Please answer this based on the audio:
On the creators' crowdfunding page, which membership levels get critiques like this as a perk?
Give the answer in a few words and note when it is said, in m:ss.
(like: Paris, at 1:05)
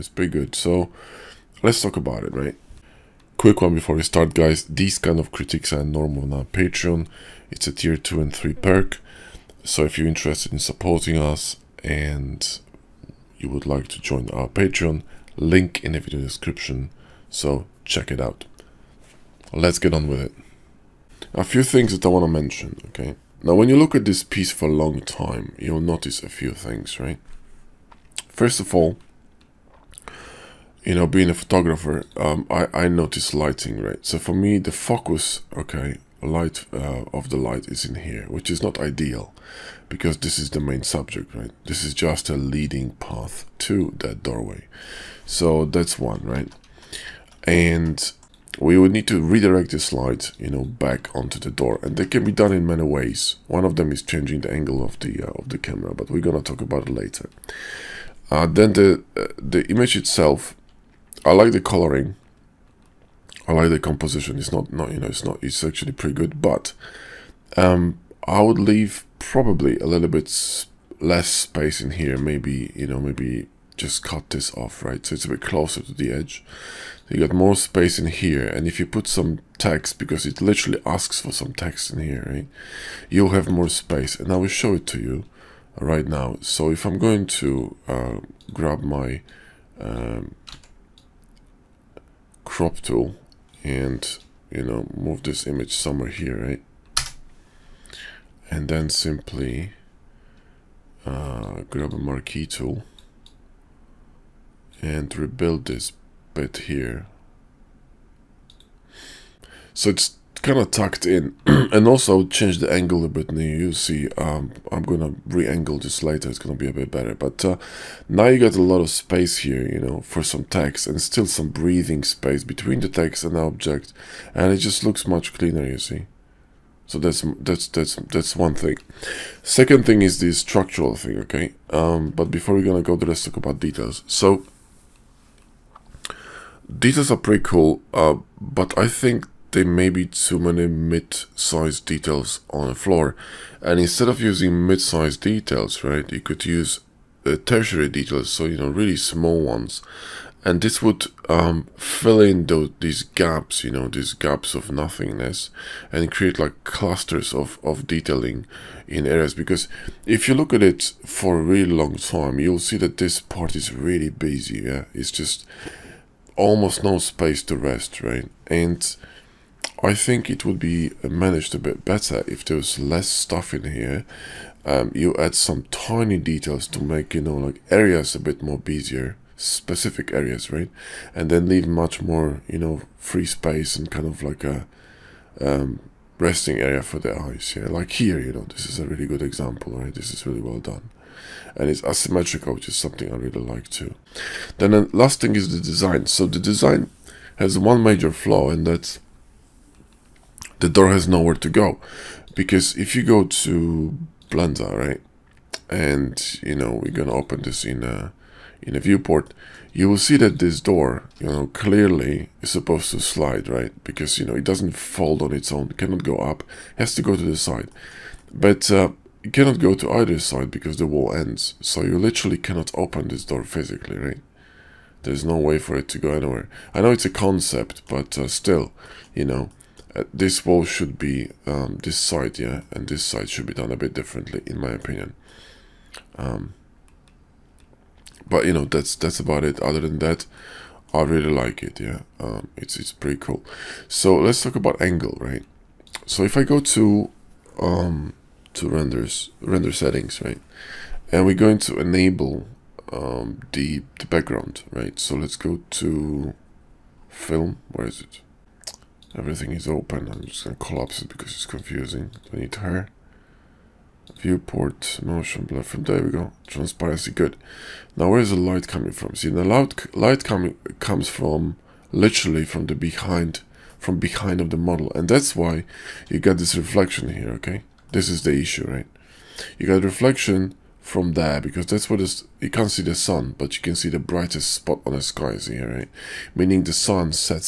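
Tier 2 and 3, at 0:07.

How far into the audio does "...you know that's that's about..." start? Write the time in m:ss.
3:58.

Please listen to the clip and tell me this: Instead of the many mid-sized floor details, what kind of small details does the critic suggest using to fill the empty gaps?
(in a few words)
Tertiary details.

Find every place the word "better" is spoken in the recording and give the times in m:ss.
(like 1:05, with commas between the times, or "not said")
1:56, 2:51.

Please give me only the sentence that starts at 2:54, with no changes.
Um, you add some tiny details to make, you know, like areas a bit more busier, specific areas, right?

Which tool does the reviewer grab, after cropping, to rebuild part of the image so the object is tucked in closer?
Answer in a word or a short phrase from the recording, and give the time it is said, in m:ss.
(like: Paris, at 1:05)
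Marquee tool, at 1:41.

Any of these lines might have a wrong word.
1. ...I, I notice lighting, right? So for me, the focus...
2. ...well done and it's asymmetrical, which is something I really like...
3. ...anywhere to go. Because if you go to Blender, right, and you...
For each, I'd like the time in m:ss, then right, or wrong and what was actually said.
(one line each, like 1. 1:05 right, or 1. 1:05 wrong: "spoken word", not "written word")
1. 0:32 right
2. 3:10 right
3. 3:21 wrong: "nowhere", not "anywhere".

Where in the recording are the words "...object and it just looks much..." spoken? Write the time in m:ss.
2:03.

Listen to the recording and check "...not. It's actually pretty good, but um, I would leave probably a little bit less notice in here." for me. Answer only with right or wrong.
wrong.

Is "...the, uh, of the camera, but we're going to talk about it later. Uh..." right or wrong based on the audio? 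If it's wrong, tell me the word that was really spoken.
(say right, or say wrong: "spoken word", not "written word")
right.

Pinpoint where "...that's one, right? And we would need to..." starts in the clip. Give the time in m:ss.
0:45.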